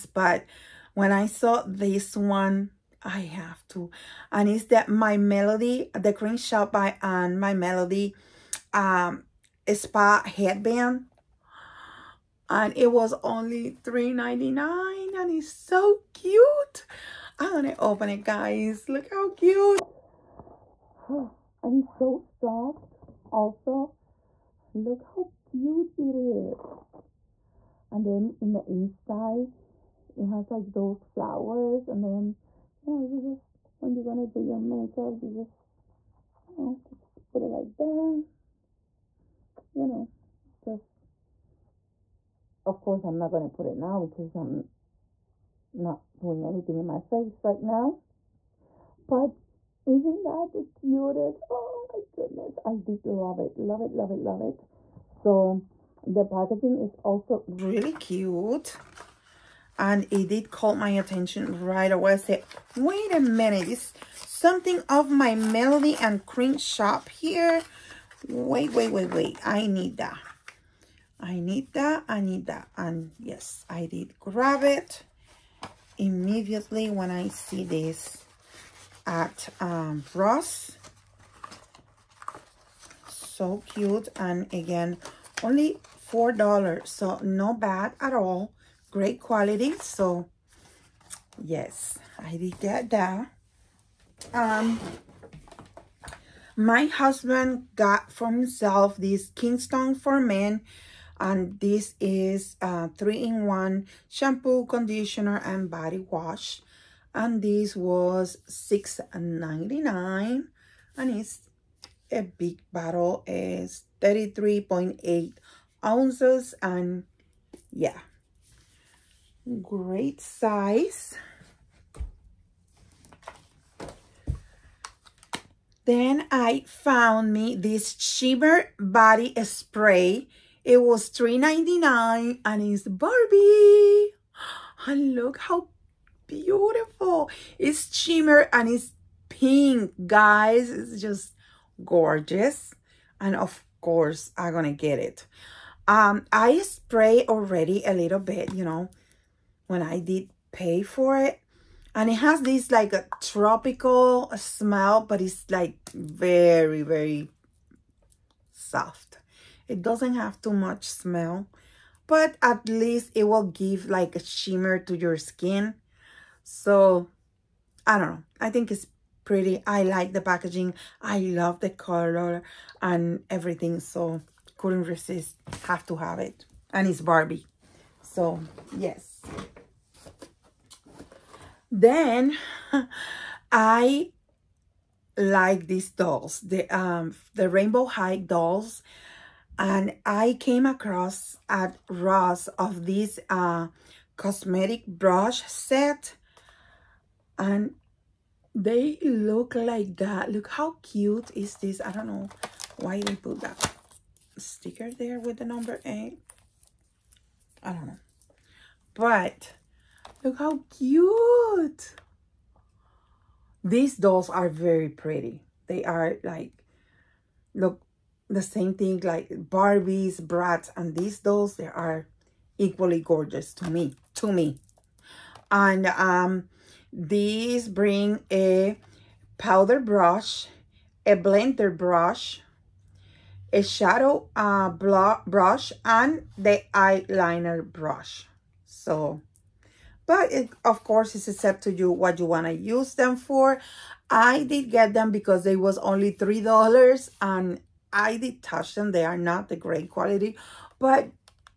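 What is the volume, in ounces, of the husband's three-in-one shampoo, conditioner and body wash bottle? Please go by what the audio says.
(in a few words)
33.8 ounces.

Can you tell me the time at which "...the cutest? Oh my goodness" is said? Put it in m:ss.
0:50.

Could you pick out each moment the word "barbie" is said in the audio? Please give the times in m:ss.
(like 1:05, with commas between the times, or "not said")
2:12, 2:56, 3:39.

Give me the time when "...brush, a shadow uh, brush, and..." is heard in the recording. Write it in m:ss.
3:51.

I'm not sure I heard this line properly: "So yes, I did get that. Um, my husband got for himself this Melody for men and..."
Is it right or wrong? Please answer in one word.
wrong.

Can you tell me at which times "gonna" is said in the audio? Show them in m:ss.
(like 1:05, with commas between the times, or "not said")
0:17, 0:34, 0:43.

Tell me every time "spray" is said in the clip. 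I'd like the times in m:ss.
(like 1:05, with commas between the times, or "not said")
2:09, 2:26.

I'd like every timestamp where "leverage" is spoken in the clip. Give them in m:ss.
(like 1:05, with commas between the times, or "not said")
not said.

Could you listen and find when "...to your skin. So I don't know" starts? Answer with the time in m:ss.
2:44.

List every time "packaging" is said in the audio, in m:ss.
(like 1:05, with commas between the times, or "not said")
0:56, 2:50.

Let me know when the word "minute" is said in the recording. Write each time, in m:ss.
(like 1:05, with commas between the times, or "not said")
1:03.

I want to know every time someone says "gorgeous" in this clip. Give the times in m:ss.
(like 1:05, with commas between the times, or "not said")
2:21, 3:42.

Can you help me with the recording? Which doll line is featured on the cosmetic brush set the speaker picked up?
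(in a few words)
Rainbow High.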